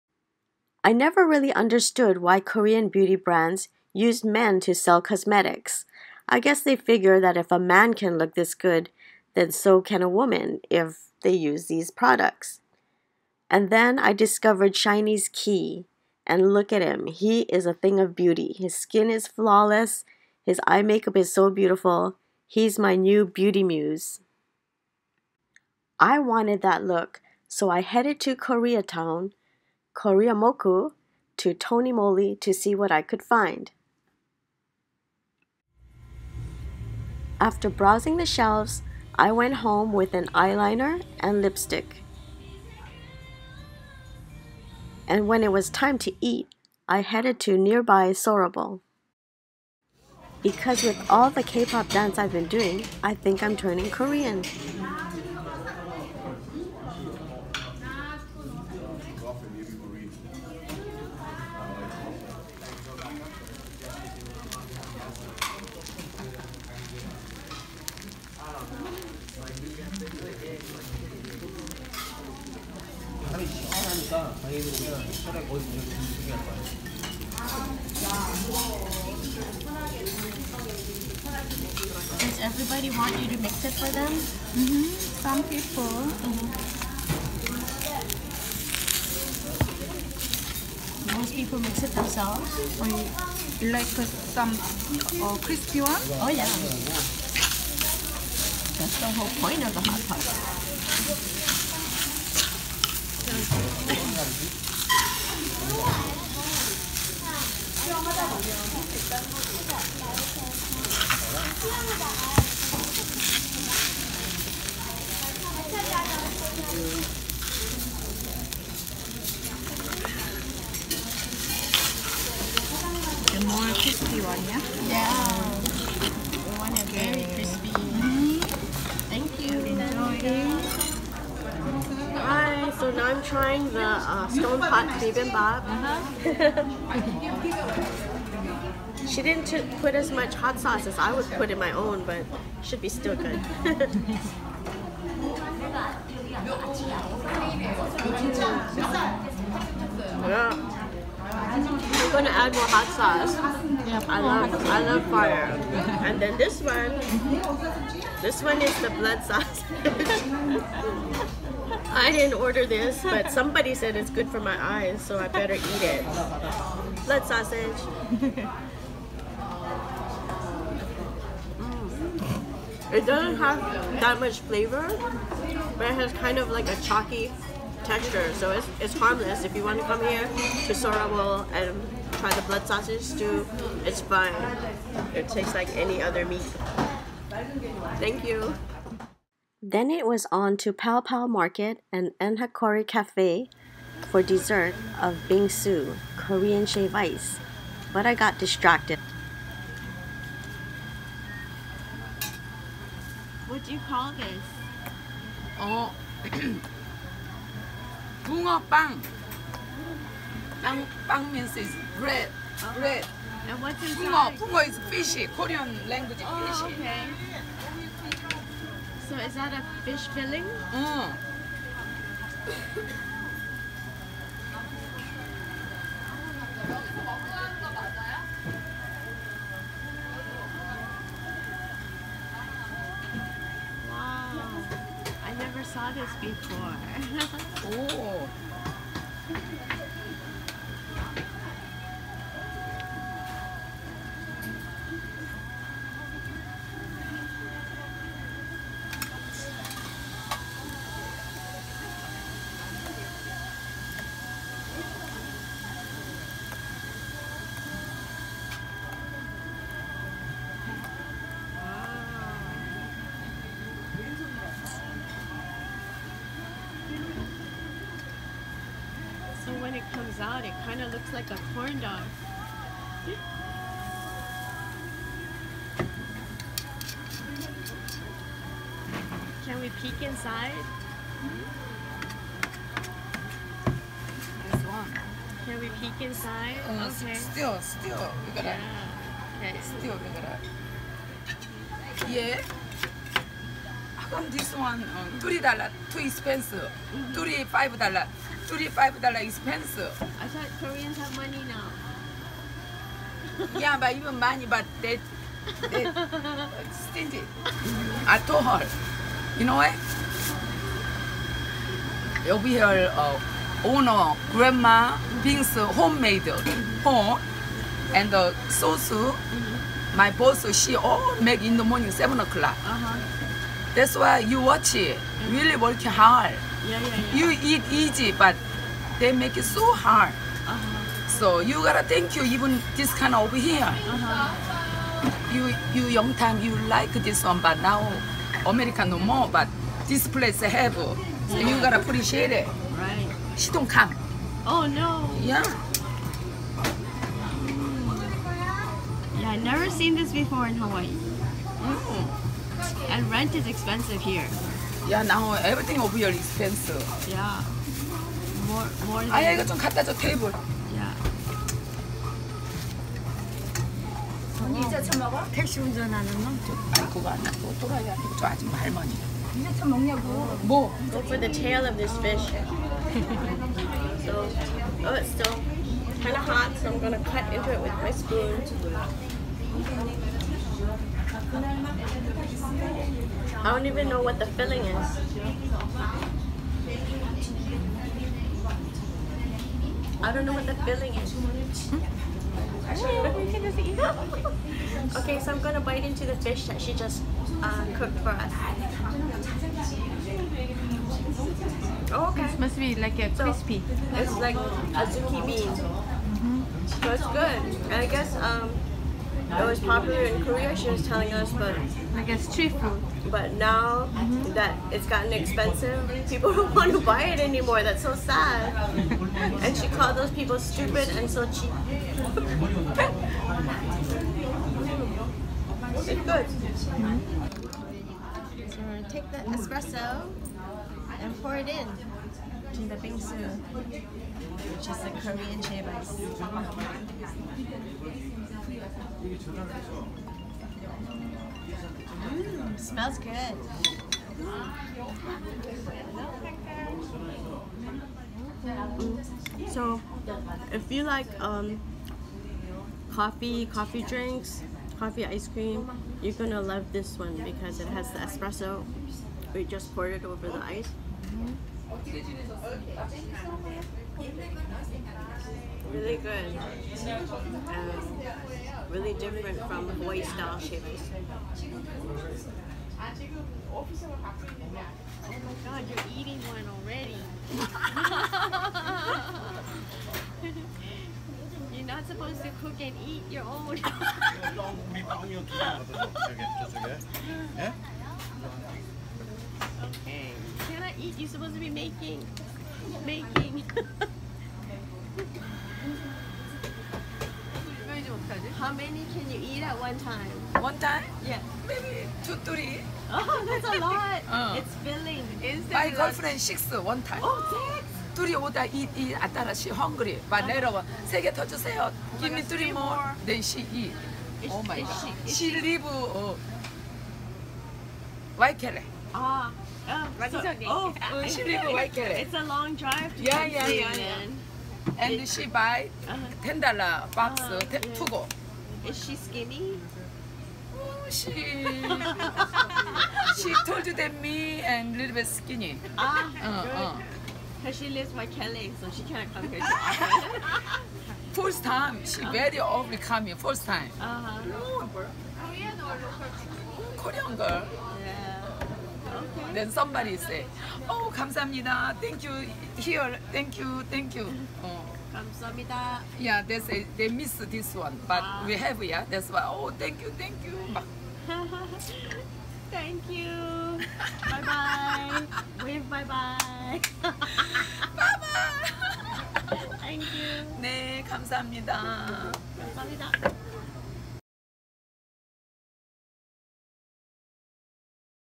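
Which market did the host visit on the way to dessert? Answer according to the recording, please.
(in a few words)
Pal Pal Market.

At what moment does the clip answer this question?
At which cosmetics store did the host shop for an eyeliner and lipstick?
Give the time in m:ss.
0:31.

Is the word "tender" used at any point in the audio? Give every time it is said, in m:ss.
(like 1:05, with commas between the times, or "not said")
not said.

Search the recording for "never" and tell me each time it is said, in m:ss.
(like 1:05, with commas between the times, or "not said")
0:00, 3:55, 5:49.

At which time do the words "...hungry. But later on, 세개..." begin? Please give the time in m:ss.
8:29.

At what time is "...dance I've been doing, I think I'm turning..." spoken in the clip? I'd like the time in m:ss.
0:51.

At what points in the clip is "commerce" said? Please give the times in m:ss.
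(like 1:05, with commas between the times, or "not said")
not said.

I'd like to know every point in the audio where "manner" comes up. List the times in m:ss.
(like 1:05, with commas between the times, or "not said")
not said.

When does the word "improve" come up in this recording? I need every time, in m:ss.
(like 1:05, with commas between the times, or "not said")
not said.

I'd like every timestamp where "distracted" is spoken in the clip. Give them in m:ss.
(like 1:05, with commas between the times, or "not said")
3:18.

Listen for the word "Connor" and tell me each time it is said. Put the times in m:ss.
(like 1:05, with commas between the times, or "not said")
not said.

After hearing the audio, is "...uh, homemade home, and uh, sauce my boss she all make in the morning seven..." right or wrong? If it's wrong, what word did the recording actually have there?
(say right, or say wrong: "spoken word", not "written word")
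right.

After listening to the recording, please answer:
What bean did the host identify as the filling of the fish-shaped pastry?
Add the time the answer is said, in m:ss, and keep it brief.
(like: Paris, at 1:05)
Azuki bean, at 6:44.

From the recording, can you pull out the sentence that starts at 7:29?
So, if you like um, coffee, coffee drinks, coffee ice cream, you're gonna love this one because it has the espresso.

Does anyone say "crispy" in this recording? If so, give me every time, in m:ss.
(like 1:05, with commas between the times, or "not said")
1:35, 2:03, 6:43.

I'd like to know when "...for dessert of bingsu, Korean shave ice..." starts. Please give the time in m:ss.
3:14.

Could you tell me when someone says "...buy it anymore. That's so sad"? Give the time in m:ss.
6:56.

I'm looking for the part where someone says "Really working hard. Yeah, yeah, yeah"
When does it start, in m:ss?
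5:25.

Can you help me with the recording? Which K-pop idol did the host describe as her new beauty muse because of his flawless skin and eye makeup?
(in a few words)
Key.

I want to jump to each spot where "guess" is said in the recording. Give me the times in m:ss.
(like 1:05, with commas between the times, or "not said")
0:06, 6:47, 6:52.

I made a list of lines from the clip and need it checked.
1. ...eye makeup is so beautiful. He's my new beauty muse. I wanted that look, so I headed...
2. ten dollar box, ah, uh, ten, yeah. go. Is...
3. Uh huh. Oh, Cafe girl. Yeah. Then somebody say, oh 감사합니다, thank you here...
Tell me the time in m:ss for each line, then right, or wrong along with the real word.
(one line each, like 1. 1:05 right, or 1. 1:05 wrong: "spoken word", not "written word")
1. 0:20 right
2. 8:46 right
3. 9:03 wrong: "Korean", not "Cafe".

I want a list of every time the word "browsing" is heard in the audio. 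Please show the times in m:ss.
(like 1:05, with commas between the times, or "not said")
0:37.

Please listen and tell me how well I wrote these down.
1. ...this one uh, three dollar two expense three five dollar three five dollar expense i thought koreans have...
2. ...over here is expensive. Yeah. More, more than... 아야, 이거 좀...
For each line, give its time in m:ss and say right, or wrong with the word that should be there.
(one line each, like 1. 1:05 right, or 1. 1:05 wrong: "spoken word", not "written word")
1. 4:54 right
2. 5:55 right.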